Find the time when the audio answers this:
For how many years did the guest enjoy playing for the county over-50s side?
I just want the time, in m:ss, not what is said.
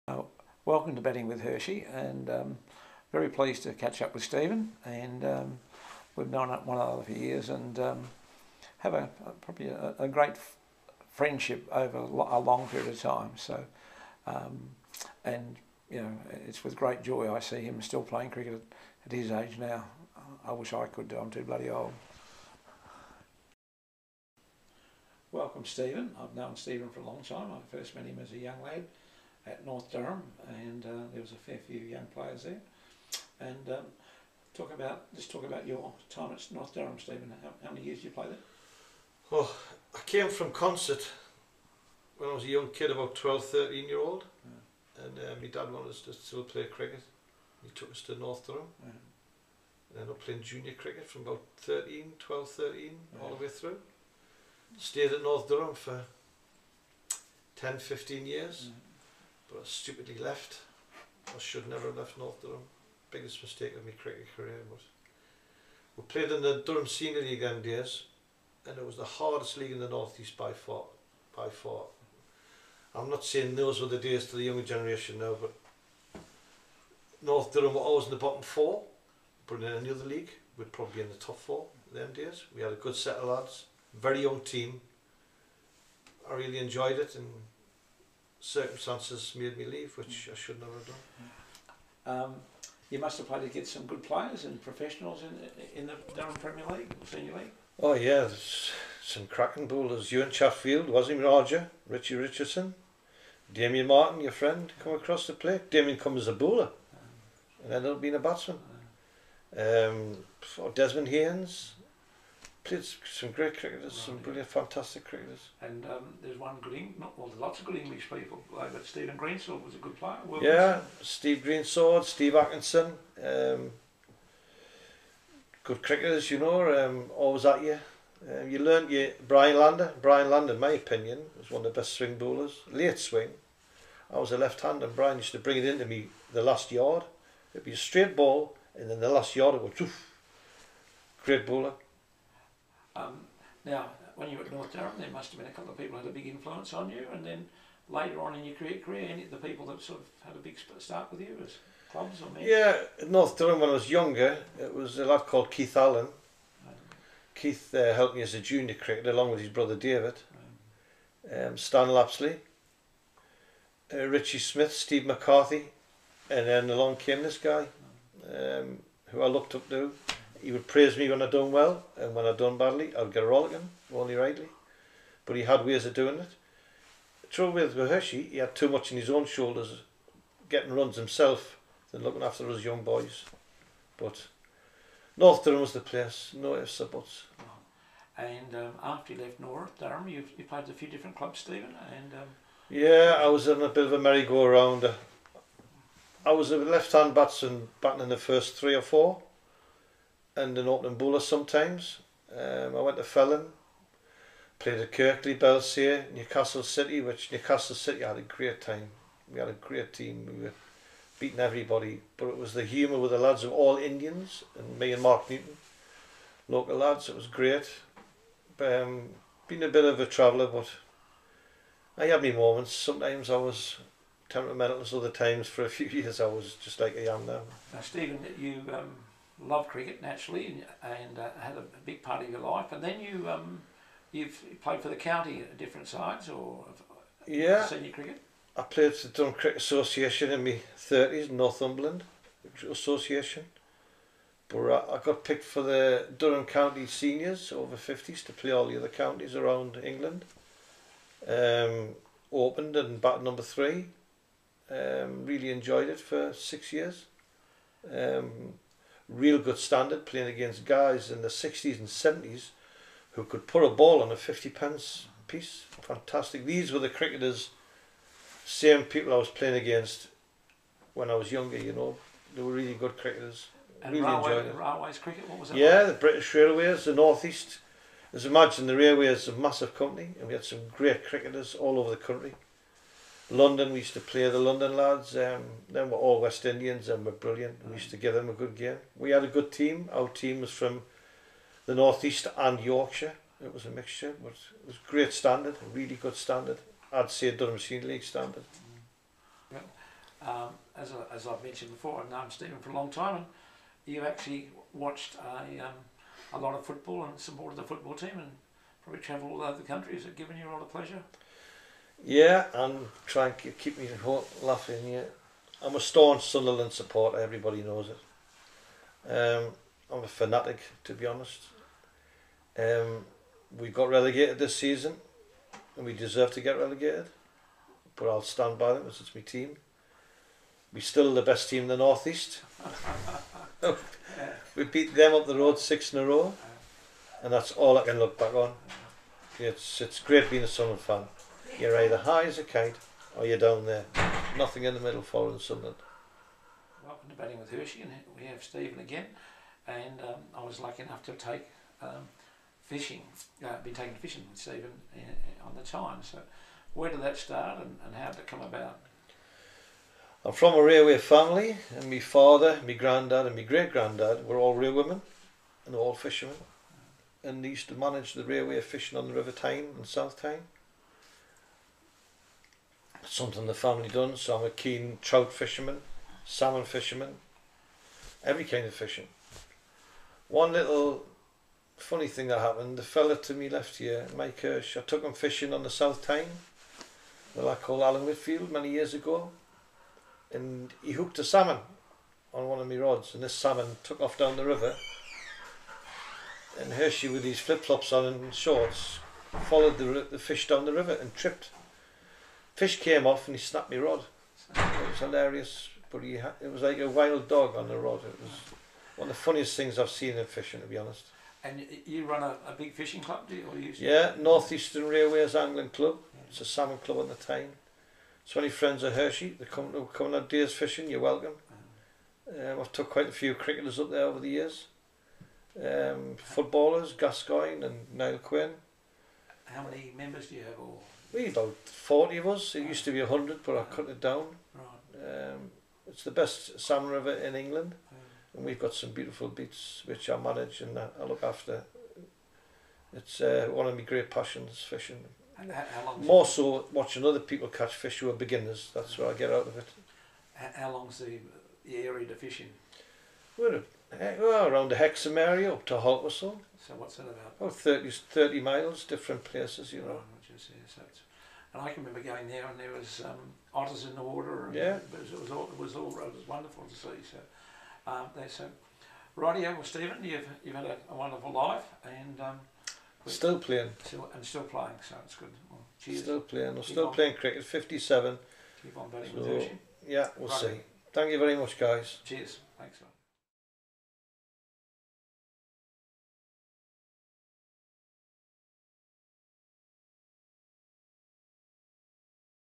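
4:16.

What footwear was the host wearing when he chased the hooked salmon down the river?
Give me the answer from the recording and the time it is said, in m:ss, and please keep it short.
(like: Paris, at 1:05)
Flip-flops, at 6:37.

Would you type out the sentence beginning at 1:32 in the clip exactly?
Um, you must have played against some good players and professionals in in the Durham Premier League, Senior League.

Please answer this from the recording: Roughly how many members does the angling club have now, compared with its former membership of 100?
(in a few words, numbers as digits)
40.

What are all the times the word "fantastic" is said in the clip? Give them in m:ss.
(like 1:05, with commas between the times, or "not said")
1:54, 4:25.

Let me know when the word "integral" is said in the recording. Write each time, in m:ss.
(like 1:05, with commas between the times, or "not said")
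not said.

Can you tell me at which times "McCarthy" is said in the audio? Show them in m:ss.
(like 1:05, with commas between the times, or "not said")
2:45.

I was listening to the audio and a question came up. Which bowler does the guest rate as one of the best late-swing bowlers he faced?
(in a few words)
Brian Lander.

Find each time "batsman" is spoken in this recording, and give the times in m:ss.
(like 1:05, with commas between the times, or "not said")
1:48, 3:17.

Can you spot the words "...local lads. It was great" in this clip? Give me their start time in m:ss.
3:36.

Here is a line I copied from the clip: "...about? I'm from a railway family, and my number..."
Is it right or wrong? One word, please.
wrong.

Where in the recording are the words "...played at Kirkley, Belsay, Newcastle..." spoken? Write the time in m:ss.
3:24.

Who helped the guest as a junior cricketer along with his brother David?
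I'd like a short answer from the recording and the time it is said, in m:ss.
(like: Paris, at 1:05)
Keith Allen, at 2:35.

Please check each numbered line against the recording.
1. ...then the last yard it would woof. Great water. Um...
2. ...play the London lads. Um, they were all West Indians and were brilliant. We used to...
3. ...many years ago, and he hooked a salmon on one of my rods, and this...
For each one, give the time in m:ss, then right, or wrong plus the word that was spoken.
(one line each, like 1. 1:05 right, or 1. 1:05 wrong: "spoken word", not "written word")
1. 2:18 wrong: "bowler", not "water"
2. 4:44 right
3. 6:28 right.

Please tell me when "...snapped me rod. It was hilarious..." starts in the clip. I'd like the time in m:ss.
6:43.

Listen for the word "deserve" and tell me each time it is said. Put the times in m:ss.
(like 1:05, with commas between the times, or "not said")
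5:25.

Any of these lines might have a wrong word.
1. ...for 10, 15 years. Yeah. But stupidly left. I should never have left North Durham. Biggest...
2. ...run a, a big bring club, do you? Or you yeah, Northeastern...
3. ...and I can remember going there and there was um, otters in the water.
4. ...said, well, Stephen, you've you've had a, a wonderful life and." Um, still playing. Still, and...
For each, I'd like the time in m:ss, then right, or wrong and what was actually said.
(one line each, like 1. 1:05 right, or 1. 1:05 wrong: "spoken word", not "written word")
1. 0:55 right
2. 6:52 wrong: "fishing", not "bring"
3. 7:41 right
4. 7:48 right.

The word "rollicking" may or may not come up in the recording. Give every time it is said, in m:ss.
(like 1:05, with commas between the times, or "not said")
2:53.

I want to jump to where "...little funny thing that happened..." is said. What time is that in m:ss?
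6:20.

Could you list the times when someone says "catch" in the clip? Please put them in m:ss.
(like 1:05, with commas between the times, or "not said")
0:03, 7:27.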